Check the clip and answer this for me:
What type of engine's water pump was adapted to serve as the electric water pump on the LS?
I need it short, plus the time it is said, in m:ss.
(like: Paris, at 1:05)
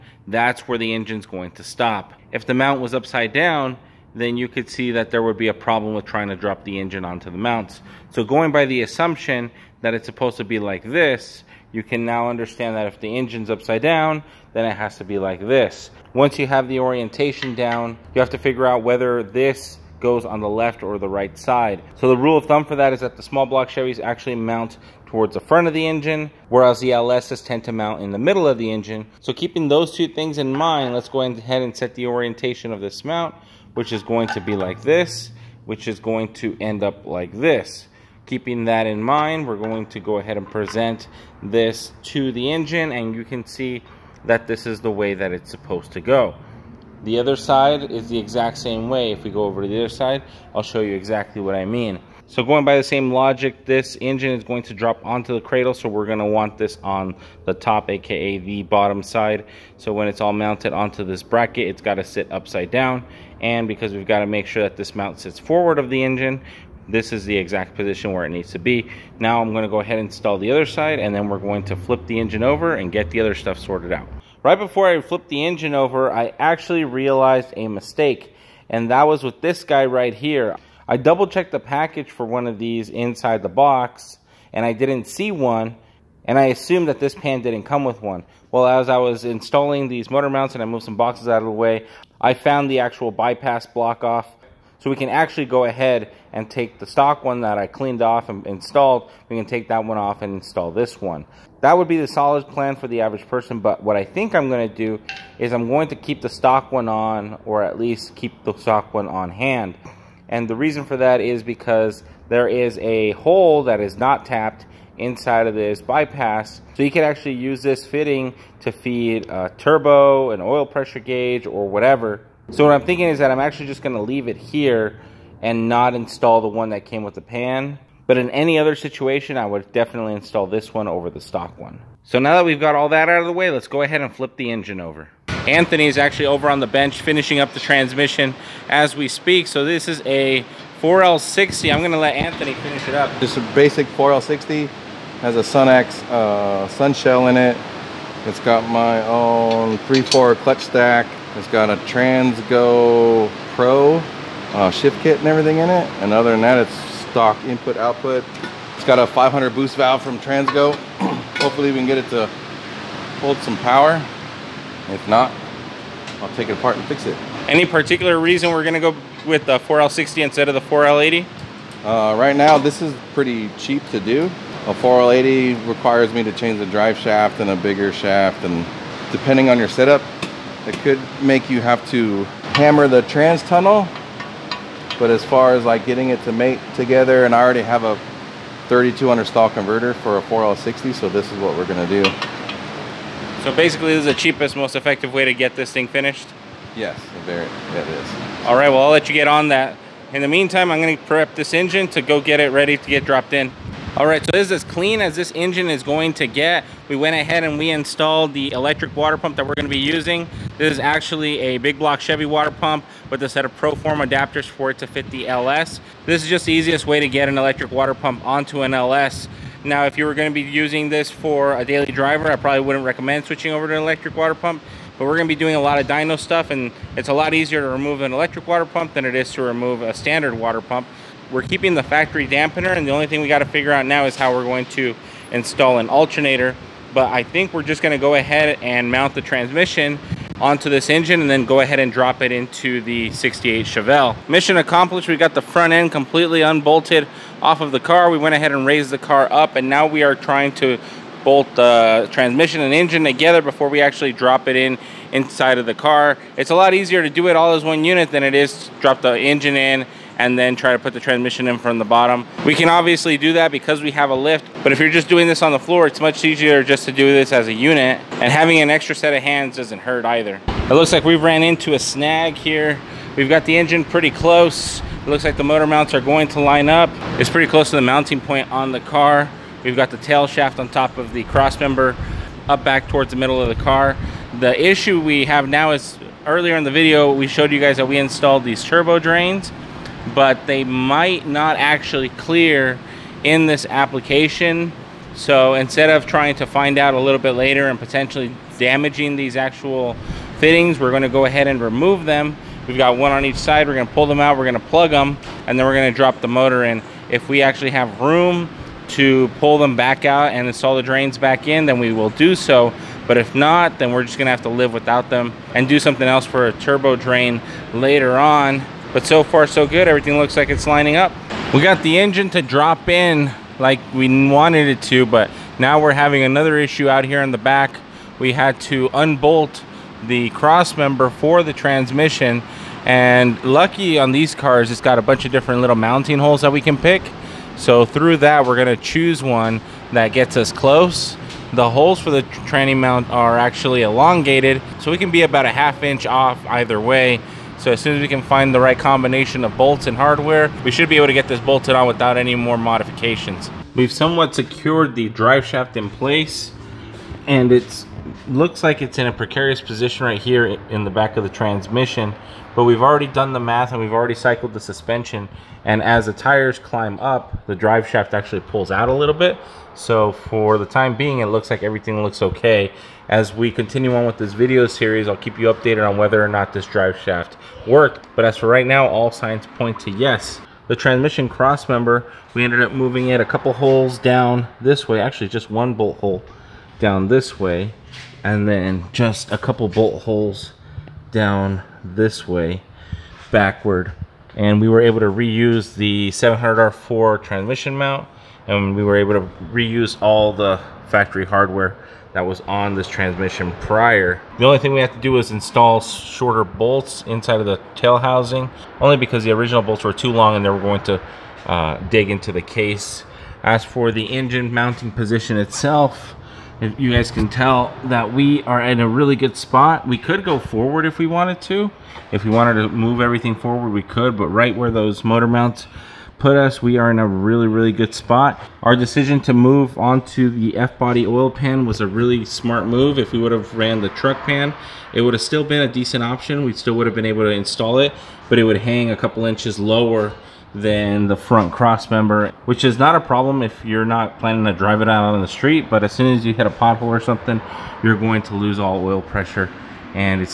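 big block Chevy, at 3:31.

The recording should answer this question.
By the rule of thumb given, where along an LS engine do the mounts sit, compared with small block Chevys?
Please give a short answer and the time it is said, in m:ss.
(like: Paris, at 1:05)
middle of the engine, at 0:28.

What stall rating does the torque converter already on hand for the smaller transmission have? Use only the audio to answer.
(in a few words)
3200.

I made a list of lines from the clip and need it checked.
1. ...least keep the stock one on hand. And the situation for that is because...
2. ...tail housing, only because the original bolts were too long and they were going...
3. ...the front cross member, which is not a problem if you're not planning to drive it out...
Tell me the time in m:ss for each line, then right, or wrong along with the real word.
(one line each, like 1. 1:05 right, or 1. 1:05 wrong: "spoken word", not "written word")
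1. 1:47 wrong: "reason", not "situation"
2. 6:47 right
3. 7:21 right.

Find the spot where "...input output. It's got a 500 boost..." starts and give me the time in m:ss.
2:37.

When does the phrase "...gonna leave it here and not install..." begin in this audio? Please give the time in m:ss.
2:03.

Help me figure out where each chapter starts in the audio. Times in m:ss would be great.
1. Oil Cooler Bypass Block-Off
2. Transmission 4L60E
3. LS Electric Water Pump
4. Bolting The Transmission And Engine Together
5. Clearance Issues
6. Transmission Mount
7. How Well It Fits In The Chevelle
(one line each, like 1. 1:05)
1. 1:13
2. 2:11
3. 3:23
4. 4:03
5. 4:30
6. 5:20
7. 6:52.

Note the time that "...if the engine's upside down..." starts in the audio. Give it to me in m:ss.
0:12.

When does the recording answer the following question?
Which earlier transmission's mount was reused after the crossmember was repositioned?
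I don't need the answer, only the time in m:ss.
6:36.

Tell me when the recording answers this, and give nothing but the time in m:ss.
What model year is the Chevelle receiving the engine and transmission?
4:03.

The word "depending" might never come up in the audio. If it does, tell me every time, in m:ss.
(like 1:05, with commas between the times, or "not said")
2:59.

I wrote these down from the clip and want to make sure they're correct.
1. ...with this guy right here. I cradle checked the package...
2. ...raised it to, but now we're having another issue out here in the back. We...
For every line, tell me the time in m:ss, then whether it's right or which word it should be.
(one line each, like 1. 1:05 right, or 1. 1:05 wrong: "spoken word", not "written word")
1. 1:19 wrong: "double", not "cradle"
2. 5:24 wrong: "wanted", not "raised".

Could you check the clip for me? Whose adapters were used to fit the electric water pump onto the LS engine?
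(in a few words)
ProForm.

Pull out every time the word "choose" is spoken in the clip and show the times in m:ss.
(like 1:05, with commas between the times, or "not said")
5:38.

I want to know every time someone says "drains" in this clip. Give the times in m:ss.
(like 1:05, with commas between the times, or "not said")
4:48, 5:10, 5:16.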